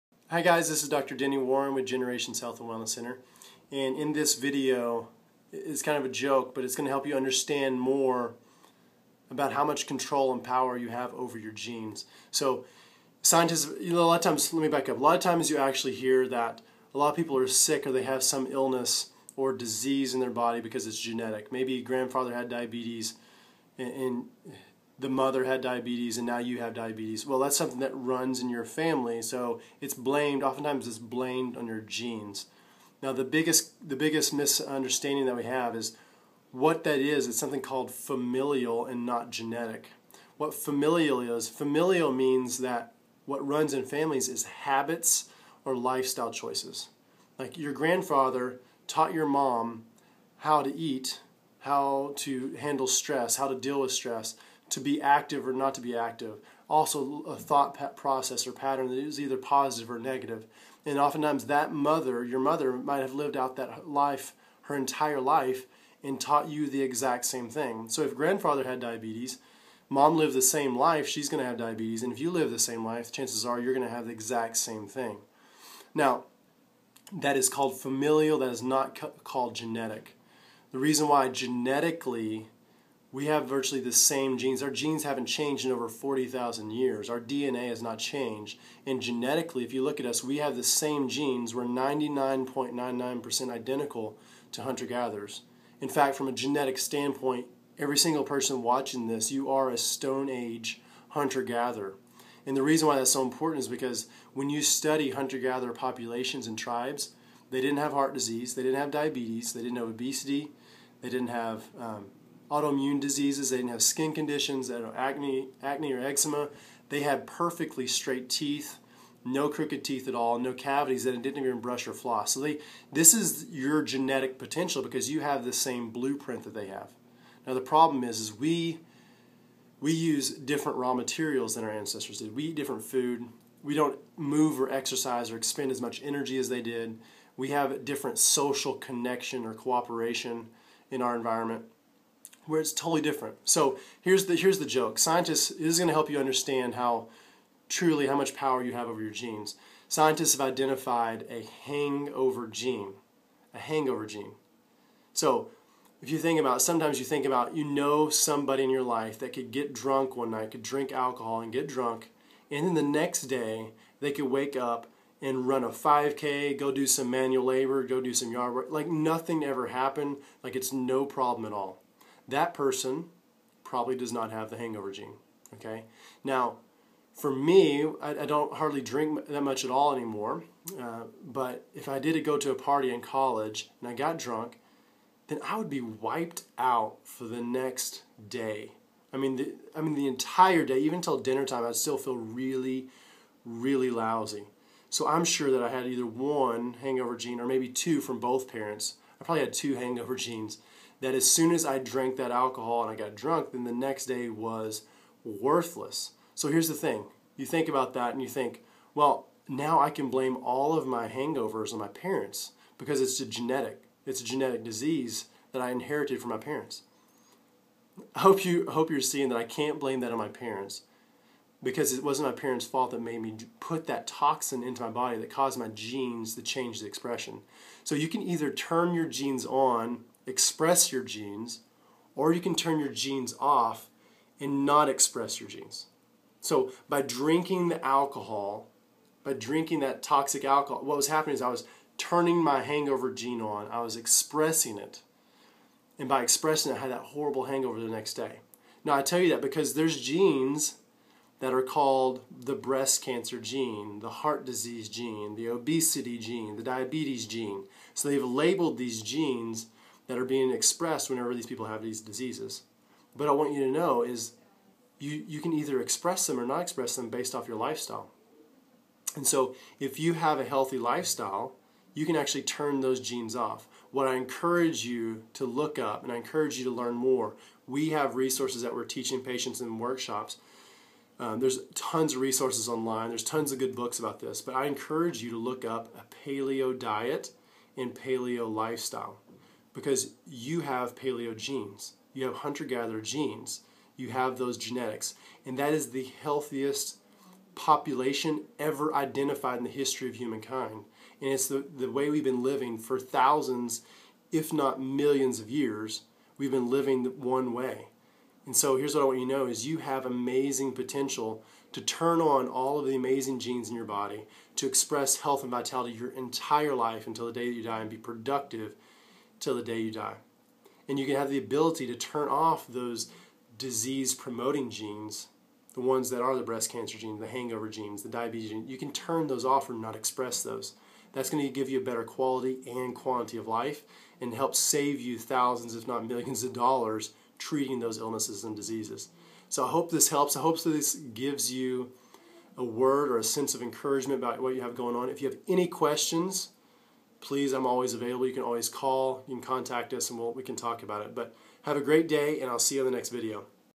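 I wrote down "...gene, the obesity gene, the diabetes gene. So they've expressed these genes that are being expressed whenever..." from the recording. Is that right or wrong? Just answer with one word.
wrong.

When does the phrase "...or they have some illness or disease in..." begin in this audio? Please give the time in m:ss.
0:17.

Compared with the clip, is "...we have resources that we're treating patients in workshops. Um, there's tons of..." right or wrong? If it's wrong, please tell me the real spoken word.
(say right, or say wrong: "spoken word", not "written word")
wrong: "teaching", not "treating".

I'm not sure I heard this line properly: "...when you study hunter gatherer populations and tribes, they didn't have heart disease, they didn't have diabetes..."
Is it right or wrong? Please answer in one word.
right.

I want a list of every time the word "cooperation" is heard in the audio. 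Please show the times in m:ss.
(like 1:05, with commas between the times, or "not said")
2:19.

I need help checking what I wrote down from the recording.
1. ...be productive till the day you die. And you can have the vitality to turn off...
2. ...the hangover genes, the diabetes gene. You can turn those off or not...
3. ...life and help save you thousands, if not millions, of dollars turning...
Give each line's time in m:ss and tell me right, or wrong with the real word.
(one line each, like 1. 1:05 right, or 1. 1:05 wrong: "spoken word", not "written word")
1. 5:17 wrong: "ability", not "vitality"
2. 5:27 right
3. 5:33 wrong: "treating", not "turning".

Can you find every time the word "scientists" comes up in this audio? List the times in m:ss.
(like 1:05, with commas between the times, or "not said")
0:13, 2:24, 2:29.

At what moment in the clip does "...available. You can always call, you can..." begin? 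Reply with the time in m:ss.
5:47.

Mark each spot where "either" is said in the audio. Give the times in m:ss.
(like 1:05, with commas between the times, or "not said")
0:59, 3:15, 3:48, 4:25.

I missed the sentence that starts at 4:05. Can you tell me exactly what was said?
And by expressing it, I had that horrible hangover the next day.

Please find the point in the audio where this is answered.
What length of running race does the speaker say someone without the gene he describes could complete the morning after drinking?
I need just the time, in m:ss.
2:45.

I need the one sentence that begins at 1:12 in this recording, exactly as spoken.
And if you live the same life, chances are you're going to have the exact same thing.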